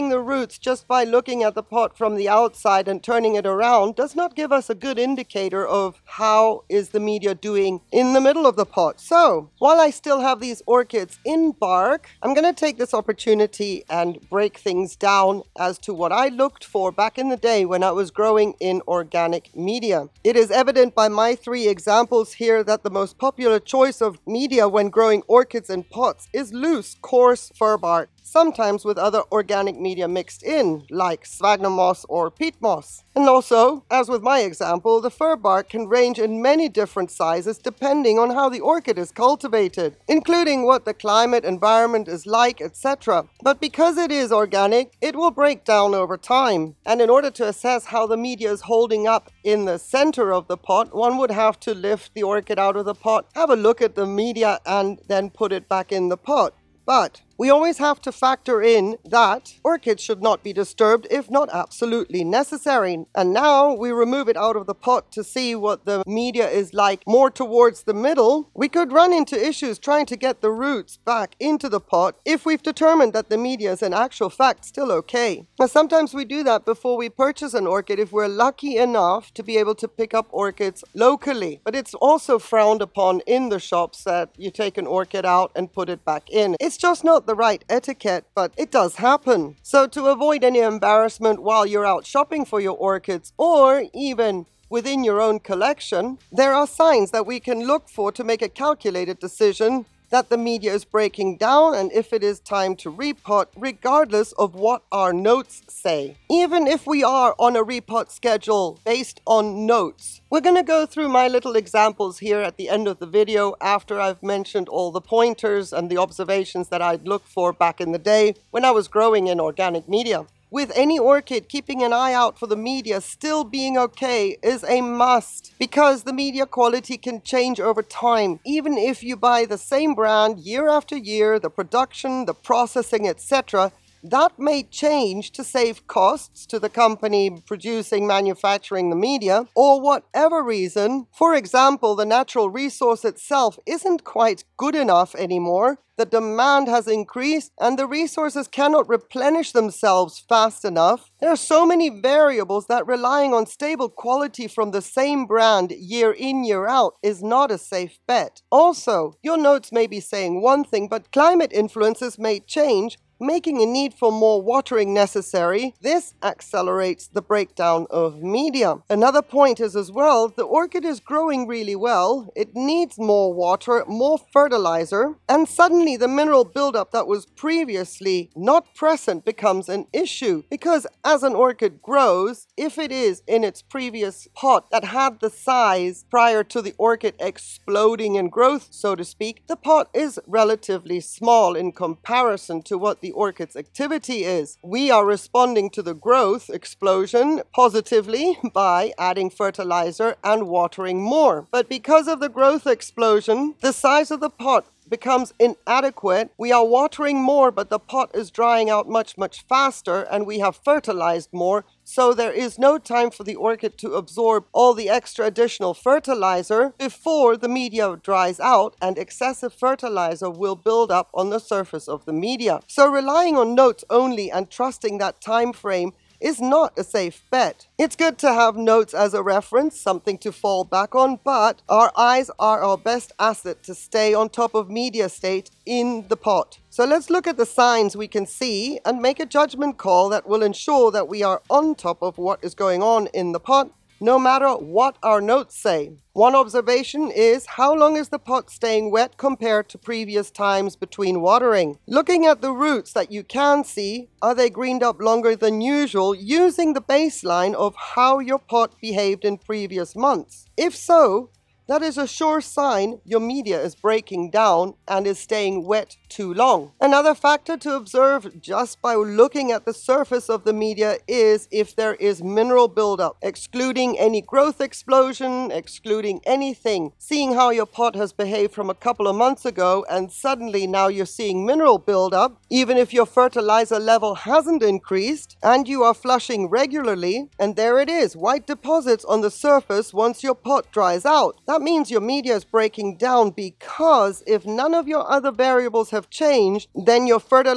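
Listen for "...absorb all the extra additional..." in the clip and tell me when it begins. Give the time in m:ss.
3:33.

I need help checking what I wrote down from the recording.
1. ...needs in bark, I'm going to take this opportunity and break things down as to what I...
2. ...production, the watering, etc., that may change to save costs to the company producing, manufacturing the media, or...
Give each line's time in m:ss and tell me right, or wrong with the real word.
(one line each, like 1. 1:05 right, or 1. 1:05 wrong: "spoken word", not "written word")
1. 0:10 wrong: "orchids", not "needs"
2. 2:11 wrong: "processing", not "watering".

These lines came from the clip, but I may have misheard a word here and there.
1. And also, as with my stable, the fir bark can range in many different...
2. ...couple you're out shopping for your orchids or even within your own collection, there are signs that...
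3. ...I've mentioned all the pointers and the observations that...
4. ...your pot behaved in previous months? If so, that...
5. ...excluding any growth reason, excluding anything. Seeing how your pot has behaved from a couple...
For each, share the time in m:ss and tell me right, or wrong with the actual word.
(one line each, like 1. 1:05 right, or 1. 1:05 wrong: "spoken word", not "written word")
1. 0:33 wrong: "example", not "stable"
2. 1:31 wrong: "while", not "couple"
3. 1:53 right
4. 4:18 right
5. 4:33 wrong: "explosion", not "reason".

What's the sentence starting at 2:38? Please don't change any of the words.
Also, your notes may be saying one thing, but climate influences may change making a need for more watering necessary.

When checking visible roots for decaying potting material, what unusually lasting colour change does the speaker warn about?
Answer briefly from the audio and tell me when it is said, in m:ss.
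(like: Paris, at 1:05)
greened up, at 4:14.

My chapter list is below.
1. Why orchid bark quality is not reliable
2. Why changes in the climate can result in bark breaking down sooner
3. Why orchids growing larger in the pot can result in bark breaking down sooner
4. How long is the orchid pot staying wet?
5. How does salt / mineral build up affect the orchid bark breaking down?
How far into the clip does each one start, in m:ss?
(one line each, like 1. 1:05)
1. 2:08
2. 2:41
3. 2:52
4. 4:08
5. 4:31.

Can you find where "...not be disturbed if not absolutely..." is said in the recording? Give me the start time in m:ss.
1:00.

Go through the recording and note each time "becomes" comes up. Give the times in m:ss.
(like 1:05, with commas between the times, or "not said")
2:59, 3:24.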